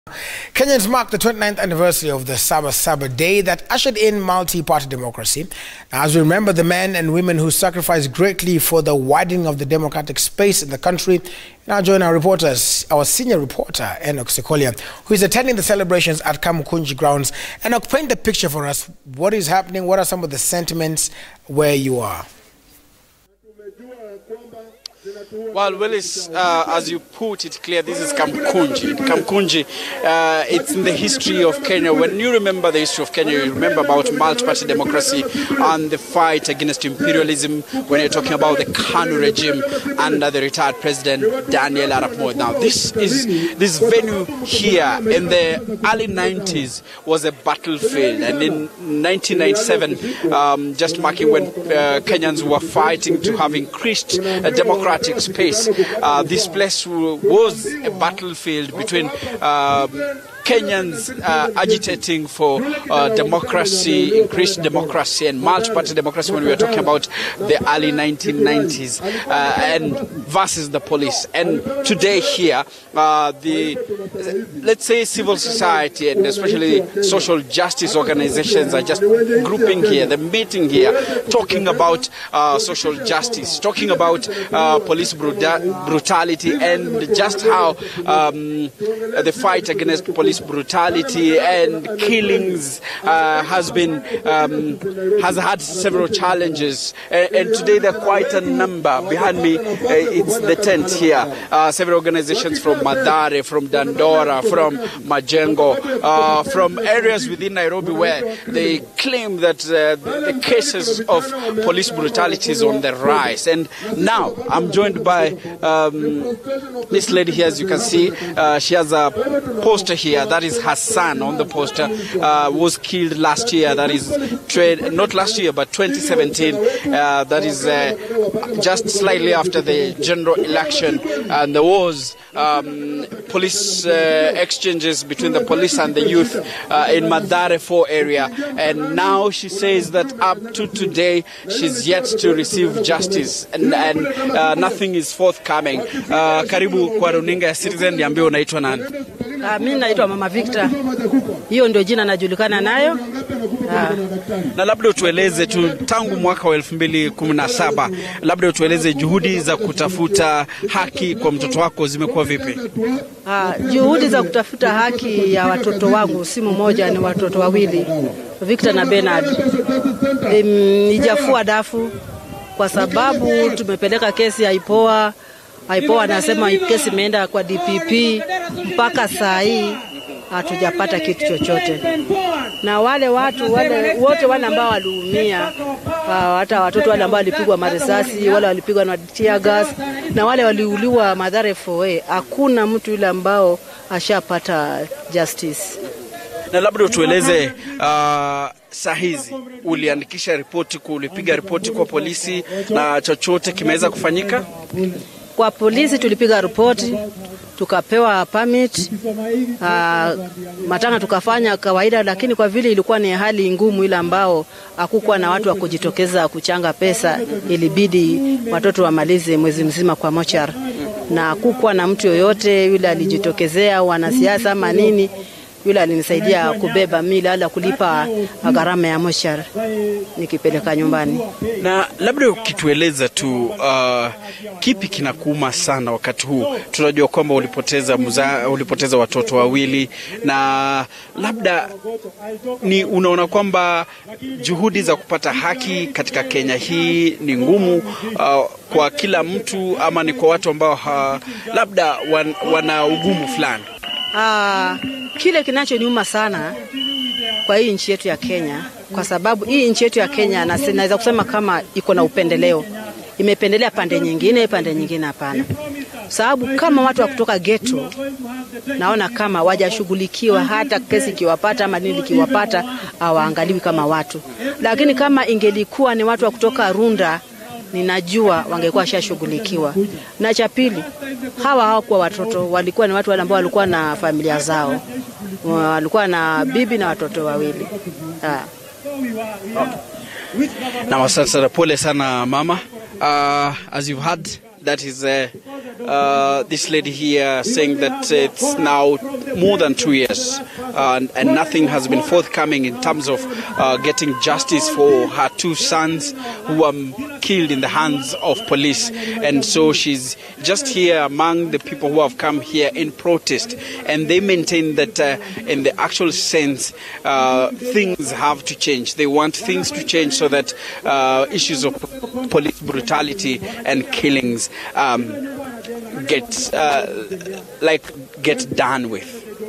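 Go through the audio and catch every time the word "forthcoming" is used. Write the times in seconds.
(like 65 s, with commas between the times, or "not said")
145 s, 302 s.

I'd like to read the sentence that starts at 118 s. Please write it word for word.
Uh, she has a poster here year.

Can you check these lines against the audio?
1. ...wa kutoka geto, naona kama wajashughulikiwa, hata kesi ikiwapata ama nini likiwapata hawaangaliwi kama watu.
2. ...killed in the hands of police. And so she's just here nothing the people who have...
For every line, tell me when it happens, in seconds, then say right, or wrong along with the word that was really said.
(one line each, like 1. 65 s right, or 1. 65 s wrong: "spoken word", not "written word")
1. 267 s right
2. 307 s wrong: "among", not "nothing".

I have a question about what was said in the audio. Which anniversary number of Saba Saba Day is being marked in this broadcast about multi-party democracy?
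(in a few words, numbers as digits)
29th.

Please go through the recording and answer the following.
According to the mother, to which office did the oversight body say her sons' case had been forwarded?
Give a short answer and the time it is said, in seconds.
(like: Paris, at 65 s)
DPP, at 177 s.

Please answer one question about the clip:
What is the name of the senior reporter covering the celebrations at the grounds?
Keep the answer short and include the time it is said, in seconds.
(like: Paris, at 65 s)
Enoch Sikolia, at 14 s.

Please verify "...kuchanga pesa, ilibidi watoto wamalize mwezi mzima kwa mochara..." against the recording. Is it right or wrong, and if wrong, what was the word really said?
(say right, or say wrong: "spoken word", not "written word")
right.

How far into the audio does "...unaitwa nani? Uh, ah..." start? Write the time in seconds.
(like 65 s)
148 s.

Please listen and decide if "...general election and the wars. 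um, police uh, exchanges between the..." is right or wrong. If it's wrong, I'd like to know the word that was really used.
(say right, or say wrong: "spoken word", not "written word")
right.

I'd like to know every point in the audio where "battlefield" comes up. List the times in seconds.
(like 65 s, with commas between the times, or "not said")
47 s, 57 s.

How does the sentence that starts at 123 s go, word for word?
That is trade, not last year, but 2017.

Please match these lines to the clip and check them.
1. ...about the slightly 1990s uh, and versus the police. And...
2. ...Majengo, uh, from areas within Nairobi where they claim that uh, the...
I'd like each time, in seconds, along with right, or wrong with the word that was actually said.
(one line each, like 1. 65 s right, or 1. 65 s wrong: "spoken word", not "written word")
1. 66 s wrong: "early", not "slightly"
2. 105 s right.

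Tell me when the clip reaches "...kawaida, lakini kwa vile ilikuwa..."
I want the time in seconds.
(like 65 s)
211 s.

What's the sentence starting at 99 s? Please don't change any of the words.
Behind me, uh, it's the tent here.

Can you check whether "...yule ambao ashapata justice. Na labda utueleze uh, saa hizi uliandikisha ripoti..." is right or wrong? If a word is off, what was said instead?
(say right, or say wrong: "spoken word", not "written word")
right.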